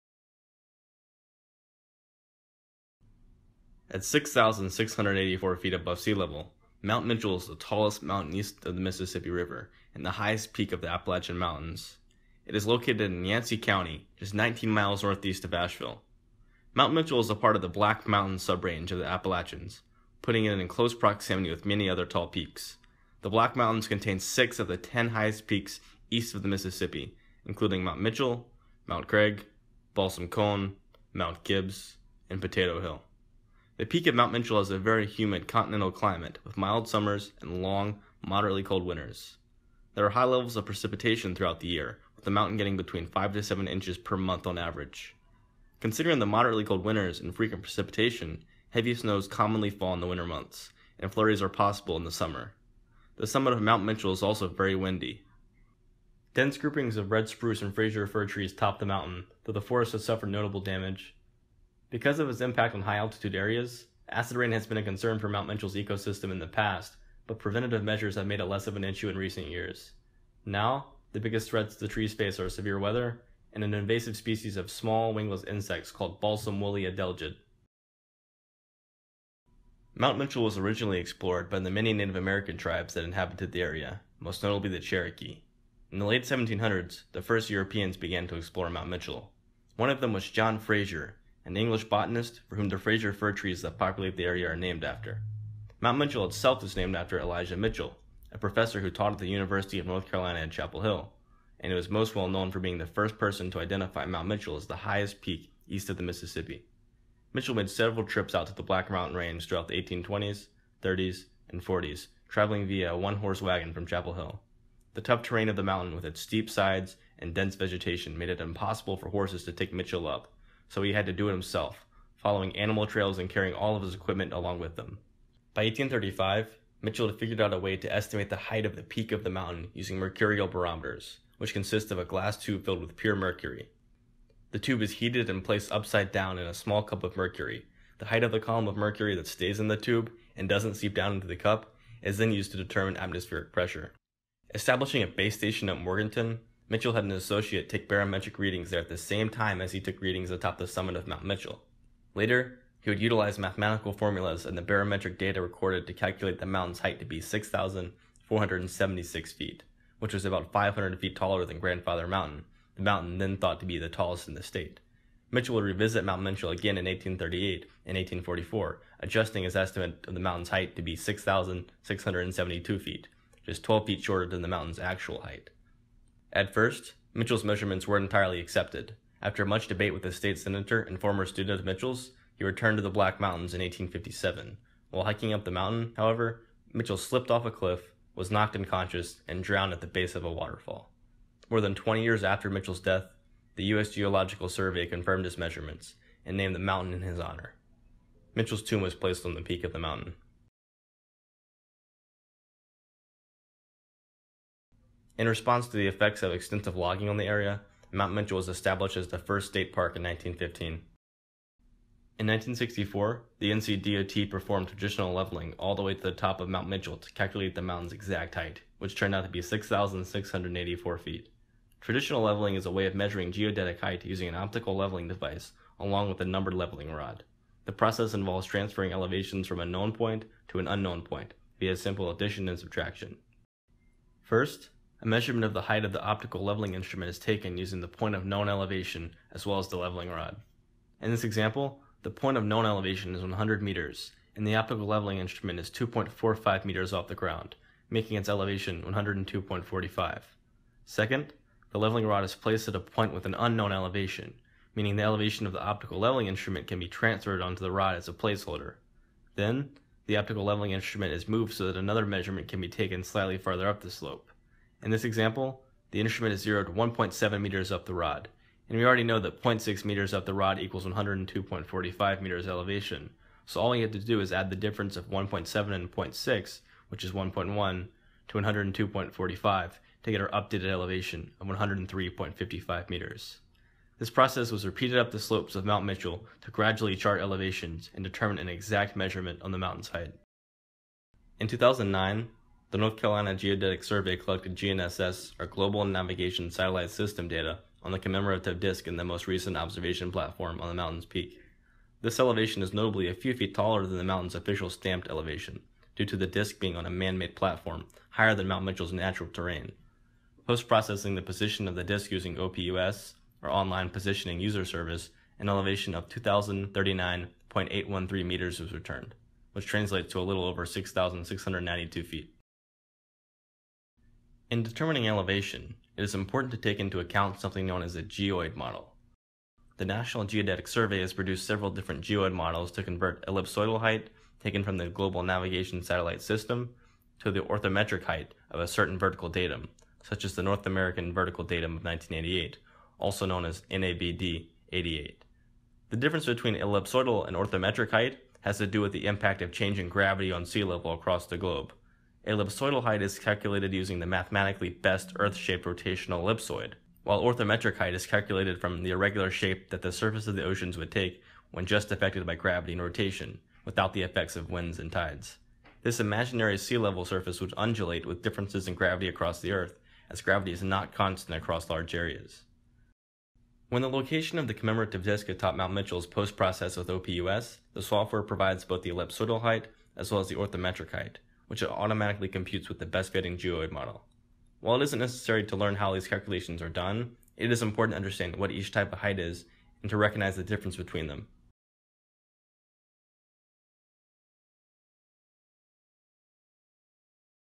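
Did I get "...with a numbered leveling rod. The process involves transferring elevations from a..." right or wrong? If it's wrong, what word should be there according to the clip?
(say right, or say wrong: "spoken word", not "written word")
right.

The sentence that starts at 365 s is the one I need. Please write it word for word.
This imaginary sea level surface would undulate with differences in gravity across the Earth, as gravity is not constant across large areas.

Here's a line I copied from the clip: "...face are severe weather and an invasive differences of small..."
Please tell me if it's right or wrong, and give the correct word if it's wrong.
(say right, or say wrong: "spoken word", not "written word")
wrong: "species", not "differences".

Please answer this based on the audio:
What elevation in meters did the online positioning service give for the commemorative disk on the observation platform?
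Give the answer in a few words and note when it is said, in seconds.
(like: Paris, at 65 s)
2,039.813 meters, at 316 s.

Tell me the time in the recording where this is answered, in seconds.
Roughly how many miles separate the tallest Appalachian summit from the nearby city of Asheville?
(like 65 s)
14 s.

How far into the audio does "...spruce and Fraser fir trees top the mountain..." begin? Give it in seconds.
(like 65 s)
57 s.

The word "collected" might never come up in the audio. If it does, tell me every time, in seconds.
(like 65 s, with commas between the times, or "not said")
294 s.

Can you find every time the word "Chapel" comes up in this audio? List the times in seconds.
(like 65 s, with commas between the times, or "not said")
100 s, 113 s.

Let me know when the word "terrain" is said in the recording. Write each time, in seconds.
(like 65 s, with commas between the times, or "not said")
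115 s, 309 s.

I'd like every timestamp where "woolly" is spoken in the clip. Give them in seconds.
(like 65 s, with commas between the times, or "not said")
76 s.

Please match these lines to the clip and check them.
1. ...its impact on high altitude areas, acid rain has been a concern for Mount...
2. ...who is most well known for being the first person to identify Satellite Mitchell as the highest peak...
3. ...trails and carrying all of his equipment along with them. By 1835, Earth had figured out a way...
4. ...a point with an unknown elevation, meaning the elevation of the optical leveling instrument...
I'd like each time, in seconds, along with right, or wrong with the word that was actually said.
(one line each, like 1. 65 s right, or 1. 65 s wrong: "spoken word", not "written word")
1. 62 s right
2. 101 s wrong: "Mount", not "Satellite"
3. 122 s wrong: "Mitchell", not "Earth"
4. 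252 s right.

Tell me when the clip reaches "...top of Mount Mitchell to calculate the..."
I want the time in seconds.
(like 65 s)
216 s.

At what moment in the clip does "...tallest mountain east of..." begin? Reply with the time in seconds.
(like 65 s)
7 s.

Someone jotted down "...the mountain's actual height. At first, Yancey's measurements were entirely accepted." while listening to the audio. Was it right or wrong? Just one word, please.
wrong.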